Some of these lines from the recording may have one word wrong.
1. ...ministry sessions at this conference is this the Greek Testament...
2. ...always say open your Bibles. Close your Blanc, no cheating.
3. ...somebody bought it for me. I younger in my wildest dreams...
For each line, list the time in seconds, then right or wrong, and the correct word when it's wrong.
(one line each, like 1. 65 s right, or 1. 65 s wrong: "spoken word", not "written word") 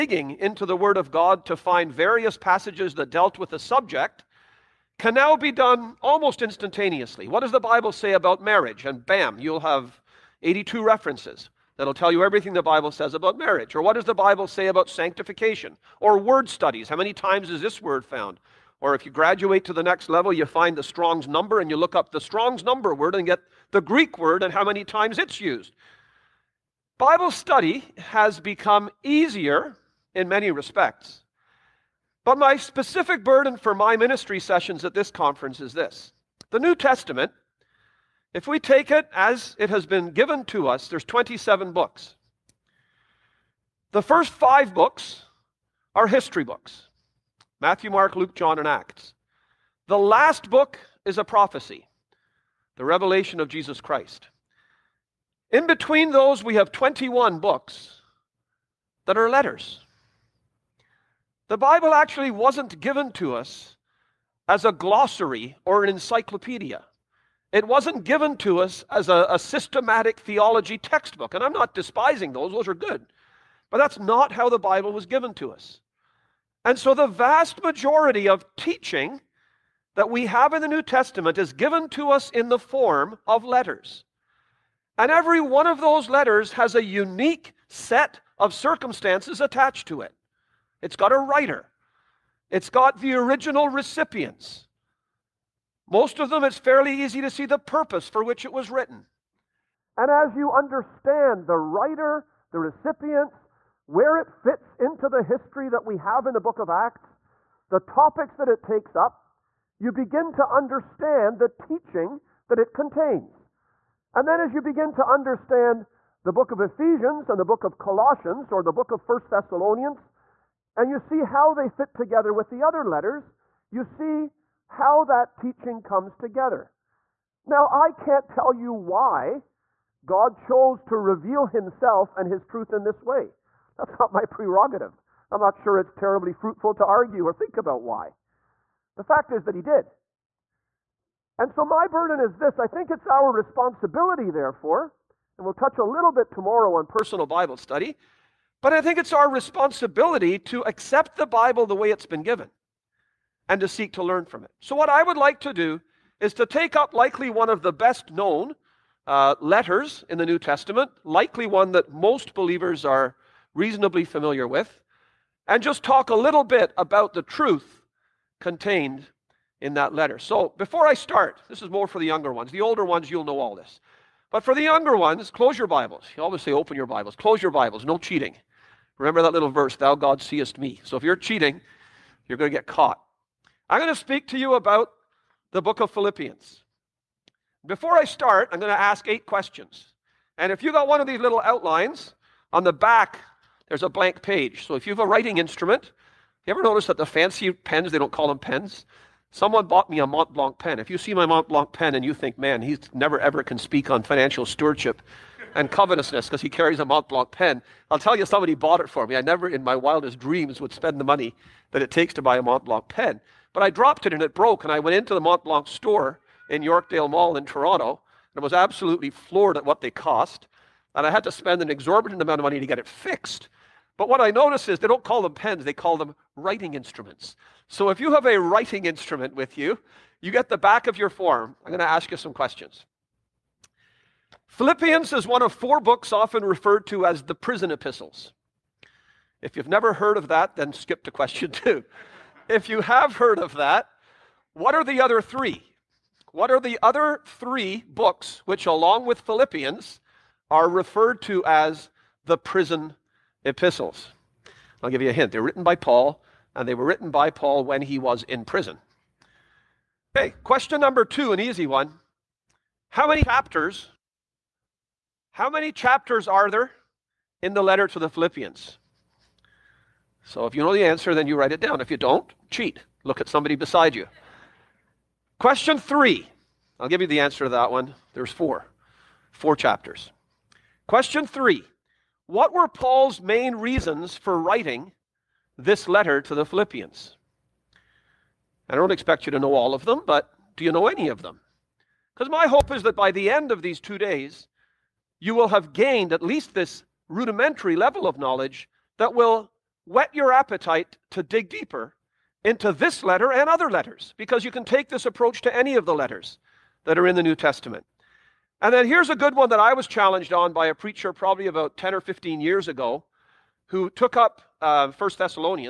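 1. 33 s wrong: "New", not "Greek"
2. 176 s wrong: "Bibles", not "Blanc"
3. 208 s wrong: "never", not "younger".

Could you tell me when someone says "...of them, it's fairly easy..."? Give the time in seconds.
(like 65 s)
96 s.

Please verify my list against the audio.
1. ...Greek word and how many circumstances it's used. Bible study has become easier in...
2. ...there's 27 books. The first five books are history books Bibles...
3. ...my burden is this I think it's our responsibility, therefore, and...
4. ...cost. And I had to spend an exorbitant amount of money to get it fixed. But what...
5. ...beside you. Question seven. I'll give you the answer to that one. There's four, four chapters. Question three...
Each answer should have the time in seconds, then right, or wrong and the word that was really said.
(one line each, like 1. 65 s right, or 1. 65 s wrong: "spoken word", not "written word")
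1. 23 s wrong: "times", not "circumstances"
2. 40 s wrong: "Matthew", not "Bibles"
3. 141 s right
4. 219 s right
5. 273 s wrong: "three", not "seven".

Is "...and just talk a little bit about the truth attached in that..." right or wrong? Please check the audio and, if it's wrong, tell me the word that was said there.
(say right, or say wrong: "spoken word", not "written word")
wrong: "contained", not "attached".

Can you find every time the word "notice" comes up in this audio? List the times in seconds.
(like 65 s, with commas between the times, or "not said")
196 s, 224 s.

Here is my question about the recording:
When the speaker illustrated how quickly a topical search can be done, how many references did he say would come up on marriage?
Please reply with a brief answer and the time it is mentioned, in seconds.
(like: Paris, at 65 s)
82, at 10 s.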